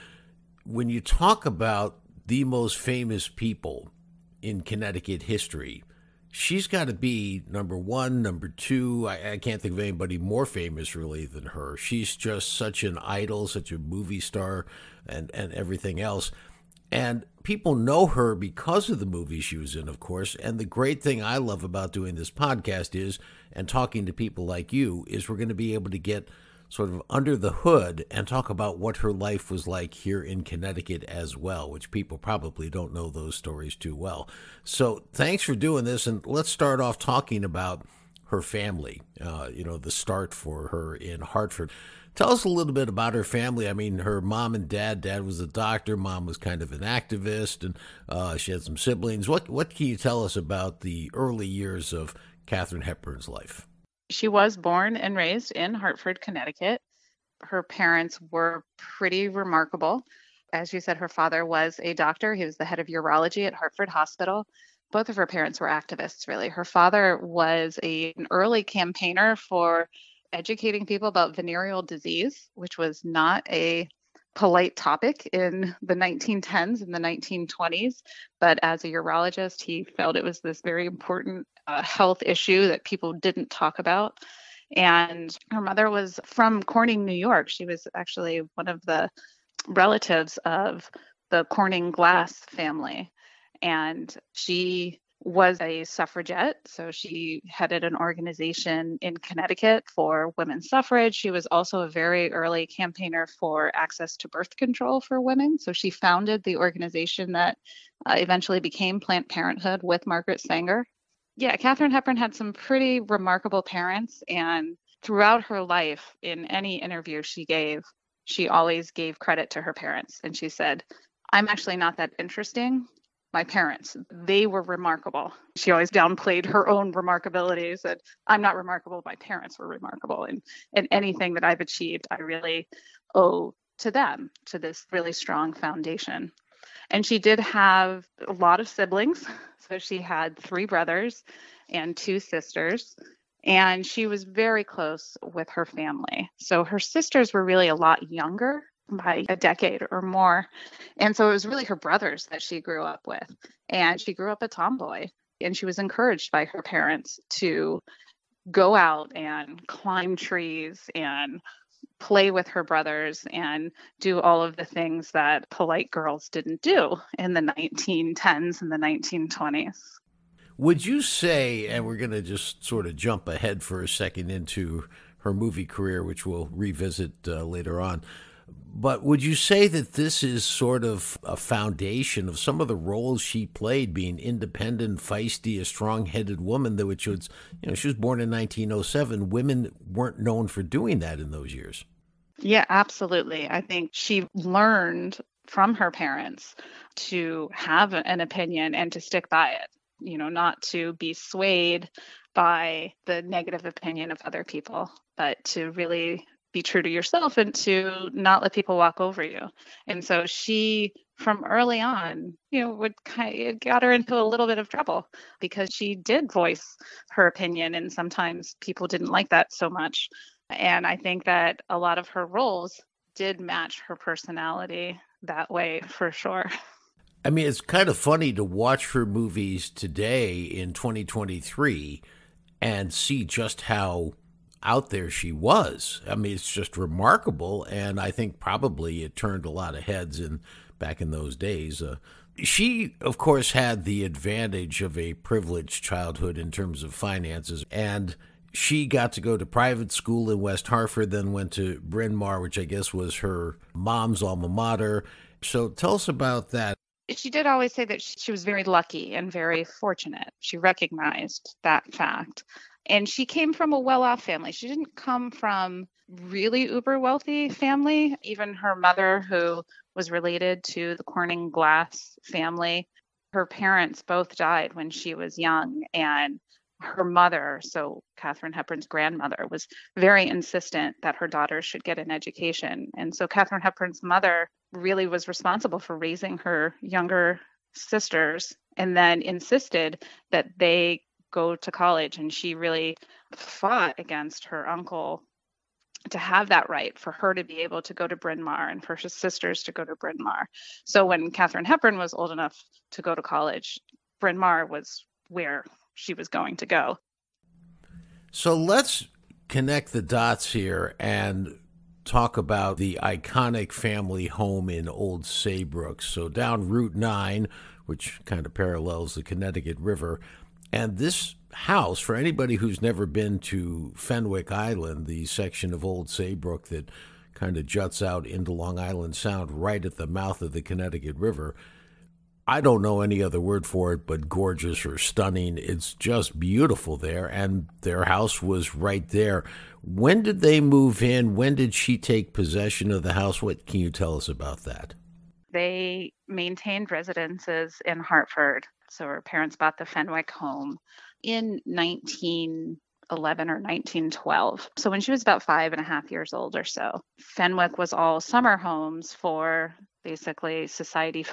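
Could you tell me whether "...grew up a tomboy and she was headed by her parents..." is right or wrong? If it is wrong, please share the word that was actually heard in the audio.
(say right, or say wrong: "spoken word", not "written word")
wrong: "encouraged", not "headed".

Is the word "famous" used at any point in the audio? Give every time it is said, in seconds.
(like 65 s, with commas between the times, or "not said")
2 s, 10 s.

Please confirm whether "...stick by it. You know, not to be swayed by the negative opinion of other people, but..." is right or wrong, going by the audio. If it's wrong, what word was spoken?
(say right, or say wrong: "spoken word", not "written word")
right.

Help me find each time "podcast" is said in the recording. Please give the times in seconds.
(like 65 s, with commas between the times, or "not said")
22 s.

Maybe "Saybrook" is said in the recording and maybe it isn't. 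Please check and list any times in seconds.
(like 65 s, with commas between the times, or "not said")
315 s, 326 s.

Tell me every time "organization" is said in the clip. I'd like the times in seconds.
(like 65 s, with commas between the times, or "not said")
97 s, 106 s.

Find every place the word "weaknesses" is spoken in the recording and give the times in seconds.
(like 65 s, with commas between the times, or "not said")
not said.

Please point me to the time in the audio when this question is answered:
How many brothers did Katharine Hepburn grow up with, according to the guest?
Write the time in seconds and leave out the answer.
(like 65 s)
140 s.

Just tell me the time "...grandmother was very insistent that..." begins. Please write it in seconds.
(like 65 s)
278 s.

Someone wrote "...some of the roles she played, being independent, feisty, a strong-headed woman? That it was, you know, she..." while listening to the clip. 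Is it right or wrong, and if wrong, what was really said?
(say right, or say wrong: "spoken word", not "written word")
right.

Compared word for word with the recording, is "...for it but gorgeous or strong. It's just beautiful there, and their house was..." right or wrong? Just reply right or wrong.
wrong.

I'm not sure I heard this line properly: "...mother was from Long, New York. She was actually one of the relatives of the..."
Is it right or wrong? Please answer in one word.
wrong.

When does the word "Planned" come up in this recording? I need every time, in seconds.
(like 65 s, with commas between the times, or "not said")
108 s.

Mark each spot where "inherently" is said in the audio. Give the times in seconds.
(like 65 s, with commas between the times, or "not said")
not said.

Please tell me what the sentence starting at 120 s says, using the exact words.
And she said, I'm actually not that interesting my parents.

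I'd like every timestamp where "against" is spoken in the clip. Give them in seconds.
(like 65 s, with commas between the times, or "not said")
293 s.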